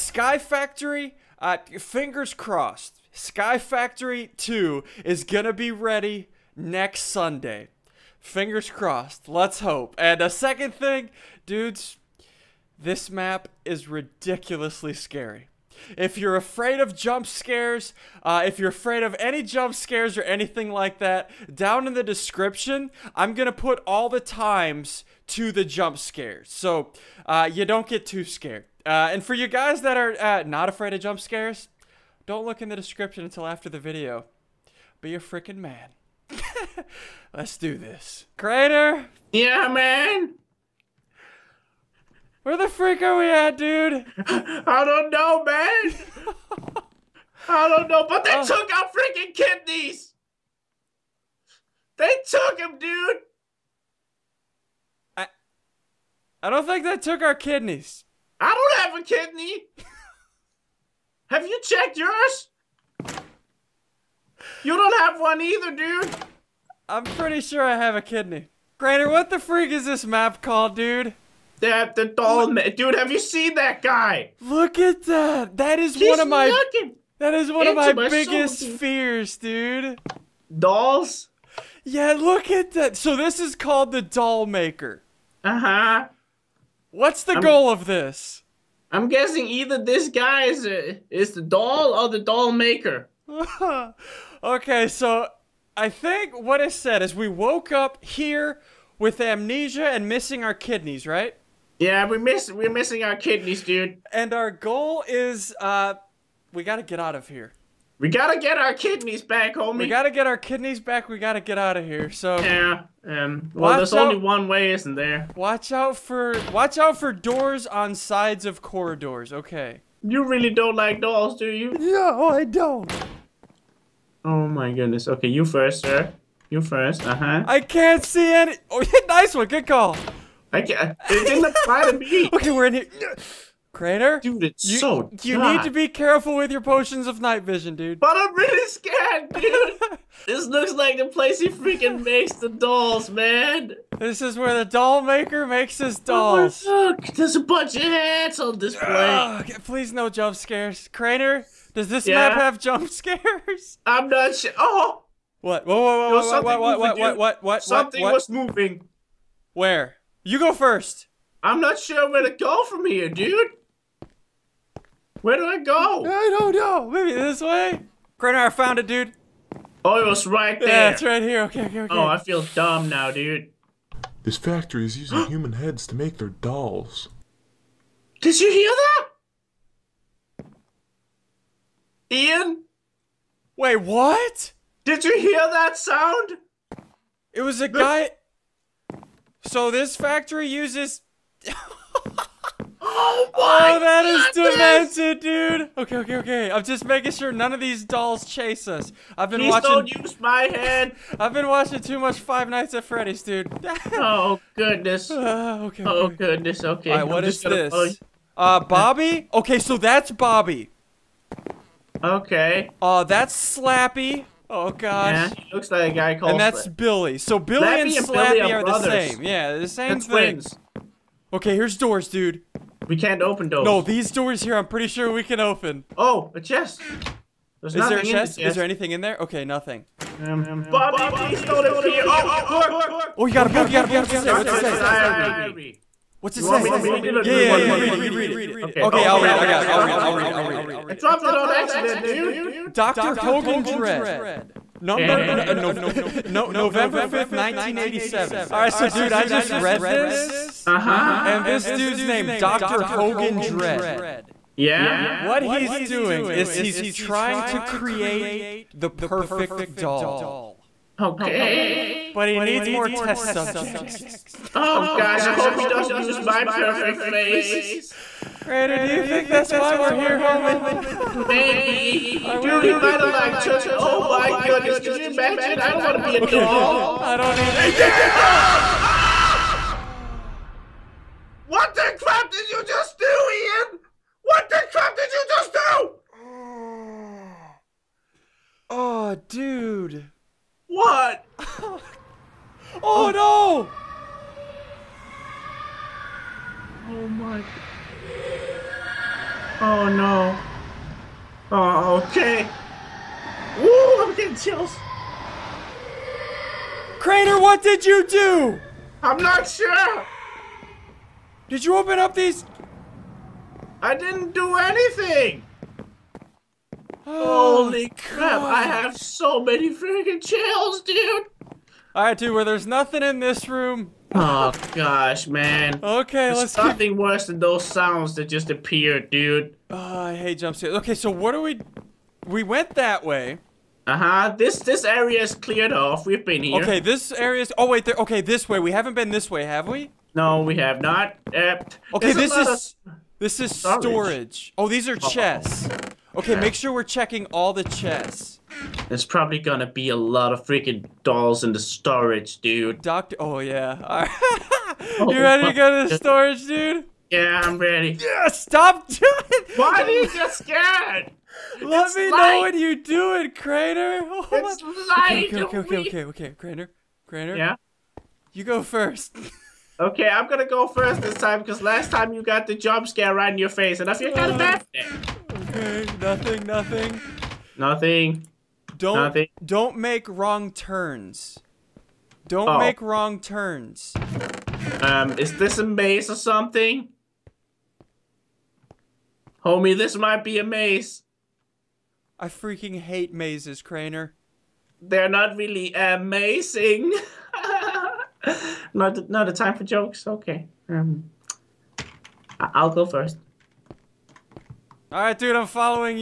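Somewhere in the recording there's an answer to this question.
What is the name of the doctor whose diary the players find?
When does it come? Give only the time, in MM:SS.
04:02.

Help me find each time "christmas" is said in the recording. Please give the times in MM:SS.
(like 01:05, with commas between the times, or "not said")
not said.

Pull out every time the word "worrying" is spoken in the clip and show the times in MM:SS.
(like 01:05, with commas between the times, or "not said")
not said.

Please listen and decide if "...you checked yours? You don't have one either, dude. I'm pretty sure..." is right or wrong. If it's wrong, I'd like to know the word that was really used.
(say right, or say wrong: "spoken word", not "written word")
right.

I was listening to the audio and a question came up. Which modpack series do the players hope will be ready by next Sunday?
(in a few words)
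Sky Factory 2.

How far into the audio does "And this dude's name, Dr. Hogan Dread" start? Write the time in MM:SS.
04:11.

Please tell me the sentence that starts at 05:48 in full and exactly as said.
There's probably gonna be a lot of freaking dolls in the storage, dude.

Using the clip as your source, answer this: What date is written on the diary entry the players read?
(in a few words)
November 5th, 1987.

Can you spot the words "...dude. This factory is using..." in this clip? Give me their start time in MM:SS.
02:53.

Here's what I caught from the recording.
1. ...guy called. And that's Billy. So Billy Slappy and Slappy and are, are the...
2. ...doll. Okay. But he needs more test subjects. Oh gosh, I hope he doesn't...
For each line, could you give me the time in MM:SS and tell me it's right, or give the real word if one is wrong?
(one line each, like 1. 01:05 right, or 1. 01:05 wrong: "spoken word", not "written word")
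1. 03:35 right
2. 04:19 right.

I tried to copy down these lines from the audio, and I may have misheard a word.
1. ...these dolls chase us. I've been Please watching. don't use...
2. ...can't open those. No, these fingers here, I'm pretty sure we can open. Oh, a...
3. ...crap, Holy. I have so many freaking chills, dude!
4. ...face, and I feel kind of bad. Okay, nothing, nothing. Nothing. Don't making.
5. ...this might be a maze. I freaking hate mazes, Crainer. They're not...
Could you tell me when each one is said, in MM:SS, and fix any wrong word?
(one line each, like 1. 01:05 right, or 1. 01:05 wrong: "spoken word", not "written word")
1. 03:17 right
2. 03:42 wrong: "doors", not "fingers"
3. 05:17 wrong: "God", not "Holy"
4. 06:13 wrong: "nothing", not "making"
5. 06:29 right.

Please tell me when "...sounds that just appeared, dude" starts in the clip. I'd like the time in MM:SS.
05:27.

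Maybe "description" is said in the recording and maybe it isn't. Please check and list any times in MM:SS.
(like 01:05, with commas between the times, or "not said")
00:22, 00:32.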